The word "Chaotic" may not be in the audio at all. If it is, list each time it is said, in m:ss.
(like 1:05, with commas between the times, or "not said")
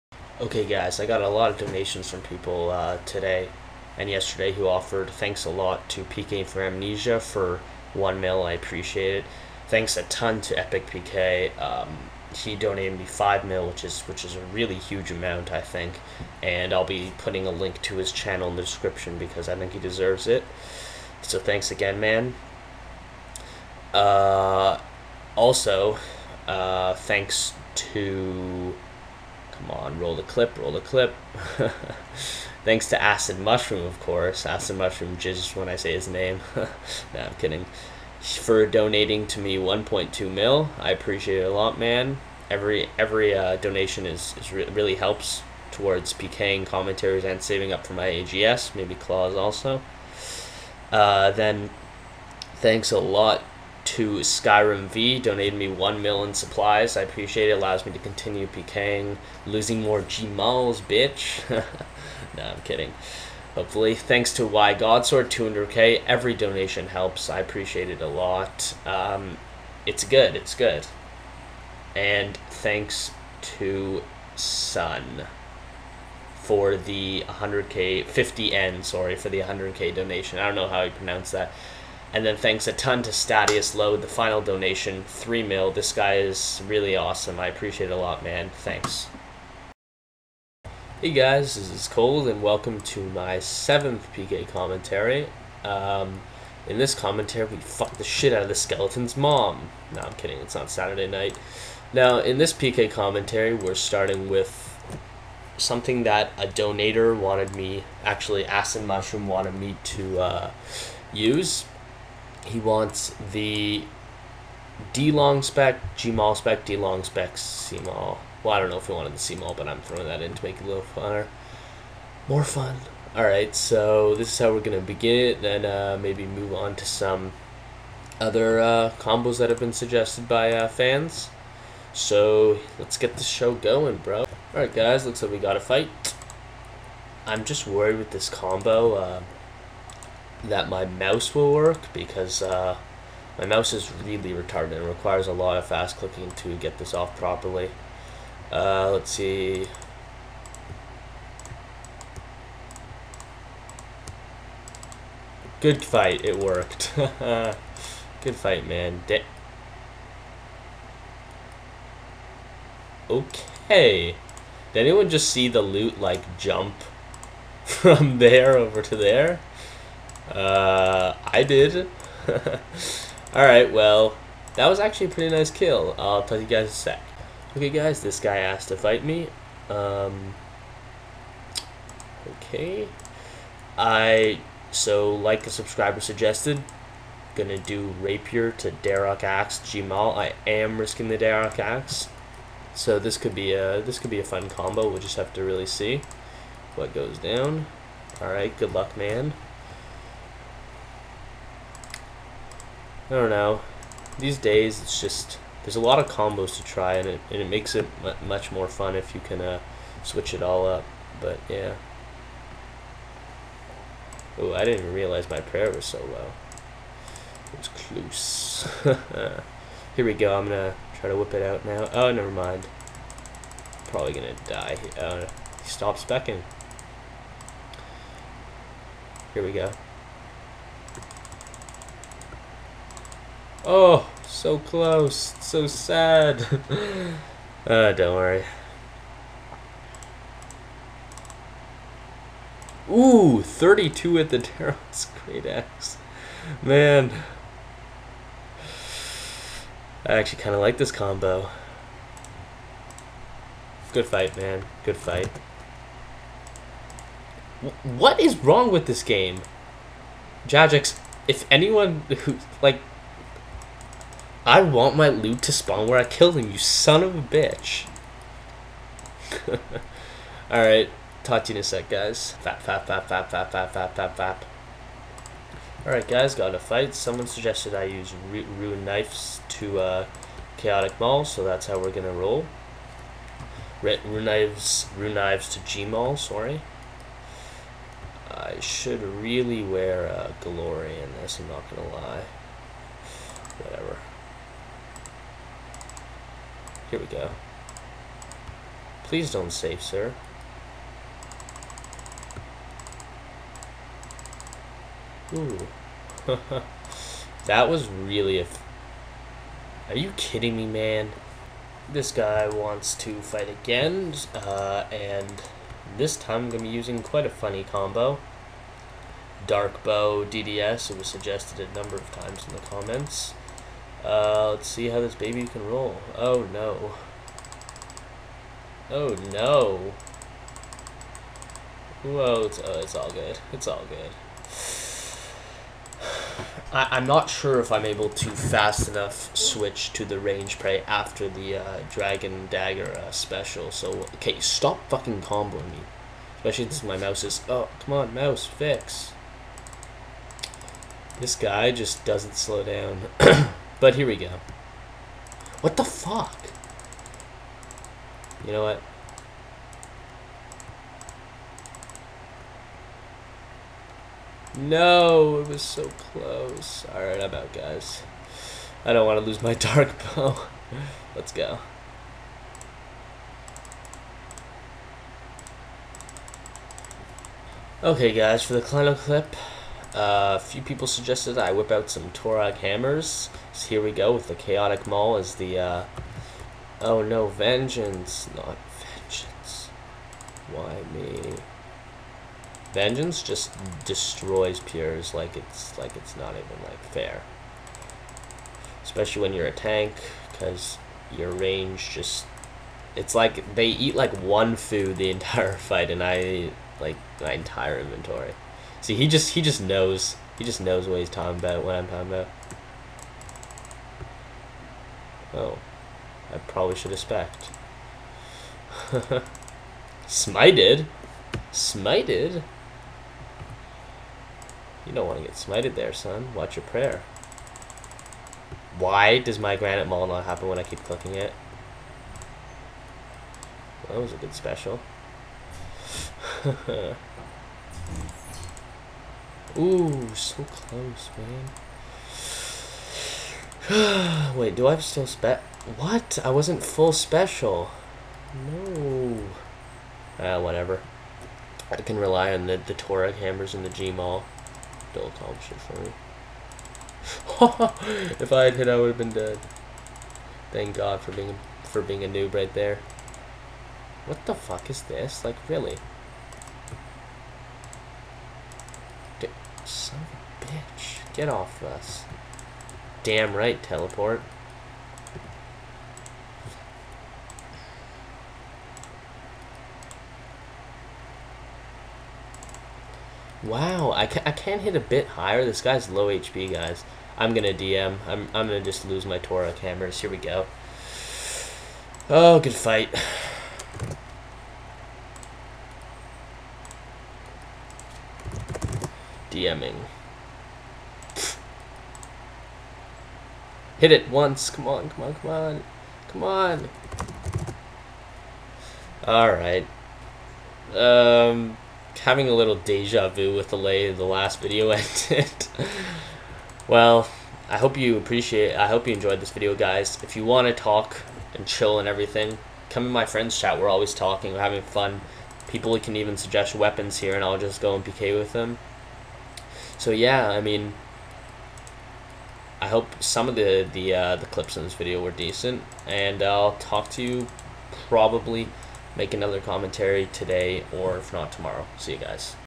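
4:40, 6:24.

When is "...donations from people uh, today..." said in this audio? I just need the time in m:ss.
0:01.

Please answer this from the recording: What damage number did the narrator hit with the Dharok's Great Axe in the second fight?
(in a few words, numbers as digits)
32.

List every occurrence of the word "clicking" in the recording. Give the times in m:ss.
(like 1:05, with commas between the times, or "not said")
2:25, 7:10.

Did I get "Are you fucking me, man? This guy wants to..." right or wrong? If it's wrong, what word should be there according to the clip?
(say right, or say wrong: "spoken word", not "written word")
wrong: "kidding", not "fucking".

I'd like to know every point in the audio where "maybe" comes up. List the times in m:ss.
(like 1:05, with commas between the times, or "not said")
0:48, 2:06.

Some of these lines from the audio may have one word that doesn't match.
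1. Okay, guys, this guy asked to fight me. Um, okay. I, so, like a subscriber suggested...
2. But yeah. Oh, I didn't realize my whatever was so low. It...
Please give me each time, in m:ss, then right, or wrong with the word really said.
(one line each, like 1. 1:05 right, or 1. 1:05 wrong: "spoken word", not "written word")
1. 2:57 right
2. 3:31 wrong: "prayer", not "whatever".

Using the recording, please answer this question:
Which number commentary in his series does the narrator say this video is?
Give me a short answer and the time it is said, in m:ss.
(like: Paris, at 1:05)
7th, at 1:33.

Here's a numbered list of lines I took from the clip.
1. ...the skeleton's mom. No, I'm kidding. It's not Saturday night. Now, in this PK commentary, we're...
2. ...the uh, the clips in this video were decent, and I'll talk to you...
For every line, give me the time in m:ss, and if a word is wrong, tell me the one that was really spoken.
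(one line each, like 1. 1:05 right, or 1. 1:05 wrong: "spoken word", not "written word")
1. 1:38 right
2. 8:53 right.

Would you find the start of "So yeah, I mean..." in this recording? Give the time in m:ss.
8:49.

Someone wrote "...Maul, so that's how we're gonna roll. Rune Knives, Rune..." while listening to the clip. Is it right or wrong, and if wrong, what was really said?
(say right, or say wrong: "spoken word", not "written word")
right.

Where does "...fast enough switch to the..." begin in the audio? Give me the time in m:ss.
5:38.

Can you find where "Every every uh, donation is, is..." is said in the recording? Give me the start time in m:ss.
0:42.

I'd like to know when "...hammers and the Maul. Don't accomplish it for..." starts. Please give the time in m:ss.
7:33.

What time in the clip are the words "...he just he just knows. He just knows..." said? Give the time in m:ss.
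6:48.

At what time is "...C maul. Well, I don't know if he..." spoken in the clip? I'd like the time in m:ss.
1:57.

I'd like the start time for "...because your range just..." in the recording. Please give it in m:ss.
6:40.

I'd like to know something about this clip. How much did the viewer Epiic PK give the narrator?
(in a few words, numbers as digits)
5 mil.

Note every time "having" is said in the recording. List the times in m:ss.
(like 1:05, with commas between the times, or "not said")
8:32, 8:44.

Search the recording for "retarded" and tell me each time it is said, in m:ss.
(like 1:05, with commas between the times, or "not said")
2:24.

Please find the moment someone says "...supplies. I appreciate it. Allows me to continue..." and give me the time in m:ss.
0:56.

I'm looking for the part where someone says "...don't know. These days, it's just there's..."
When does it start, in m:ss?
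3:23.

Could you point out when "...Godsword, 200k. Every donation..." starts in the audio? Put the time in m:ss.
1:04.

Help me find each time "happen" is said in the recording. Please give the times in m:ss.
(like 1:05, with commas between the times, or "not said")
7:10.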